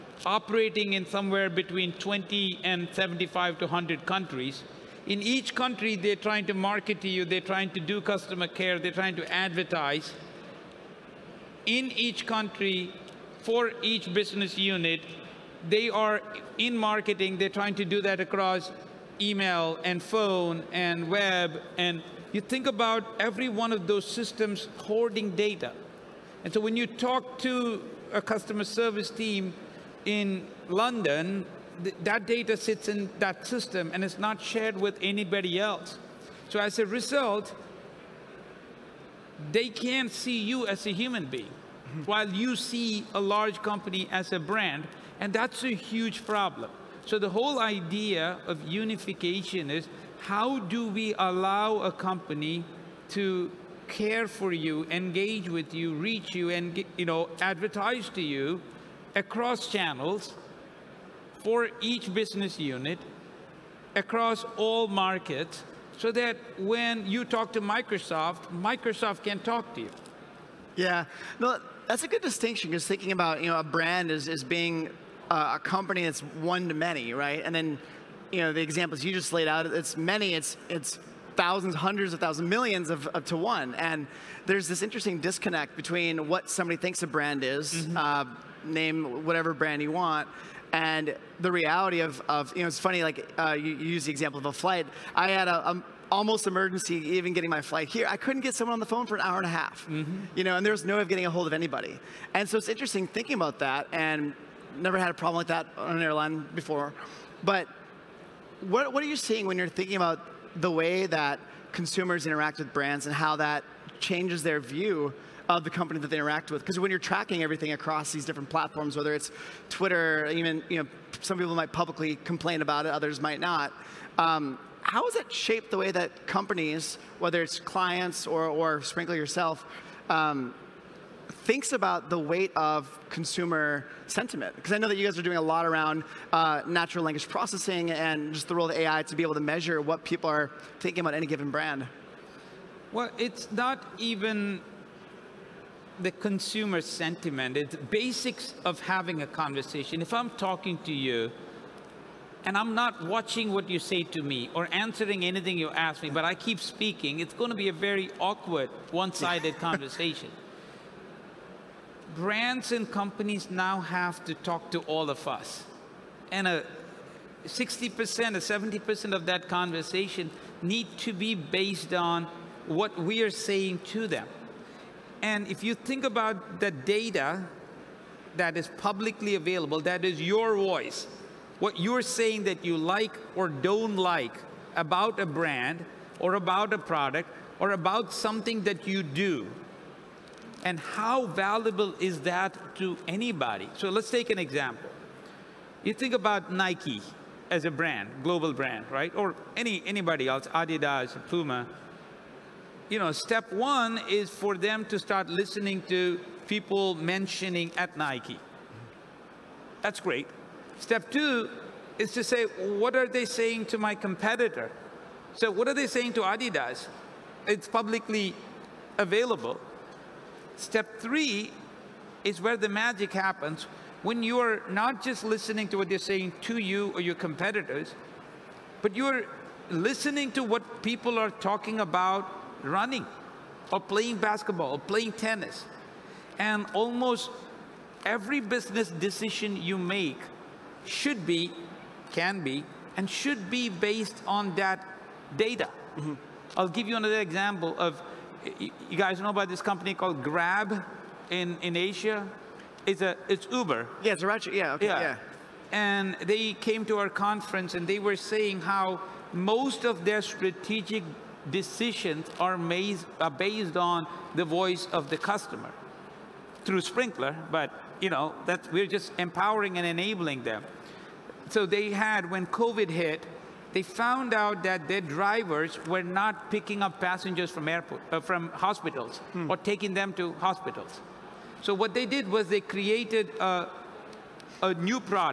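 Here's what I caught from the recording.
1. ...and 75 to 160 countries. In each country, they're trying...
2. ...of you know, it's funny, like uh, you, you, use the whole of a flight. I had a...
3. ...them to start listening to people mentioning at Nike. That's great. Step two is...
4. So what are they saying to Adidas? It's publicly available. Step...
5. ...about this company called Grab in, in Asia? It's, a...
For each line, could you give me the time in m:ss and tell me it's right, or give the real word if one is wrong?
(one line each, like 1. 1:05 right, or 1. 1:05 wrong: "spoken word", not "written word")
1. 0:02 wrong: "100", not "160"
2. 1:32 wrong: "example", not "whole"
3. 3:24 right
4. 3:35 right
5. 4:09 right.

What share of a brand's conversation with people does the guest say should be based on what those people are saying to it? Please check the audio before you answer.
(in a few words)
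60% or 70%.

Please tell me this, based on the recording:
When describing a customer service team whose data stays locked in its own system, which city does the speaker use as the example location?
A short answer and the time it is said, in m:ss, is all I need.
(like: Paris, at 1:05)
London, at 0:30.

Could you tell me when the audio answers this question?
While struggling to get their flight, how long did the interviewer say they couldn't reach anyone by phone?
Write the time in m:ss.
1:39.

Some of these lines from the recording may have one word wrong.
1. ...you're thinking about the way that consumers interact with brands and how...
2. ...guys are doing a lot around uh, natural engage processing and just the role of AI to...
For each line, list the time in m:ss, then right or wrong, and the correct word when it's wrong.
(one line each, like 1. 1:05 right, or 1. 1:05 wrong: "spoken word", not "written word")
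1. 1:49 right
2. 2:15 wrong: "language", not "engage".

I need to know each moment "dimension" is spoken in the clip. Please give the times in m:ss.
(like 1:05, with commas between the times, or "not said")
not said.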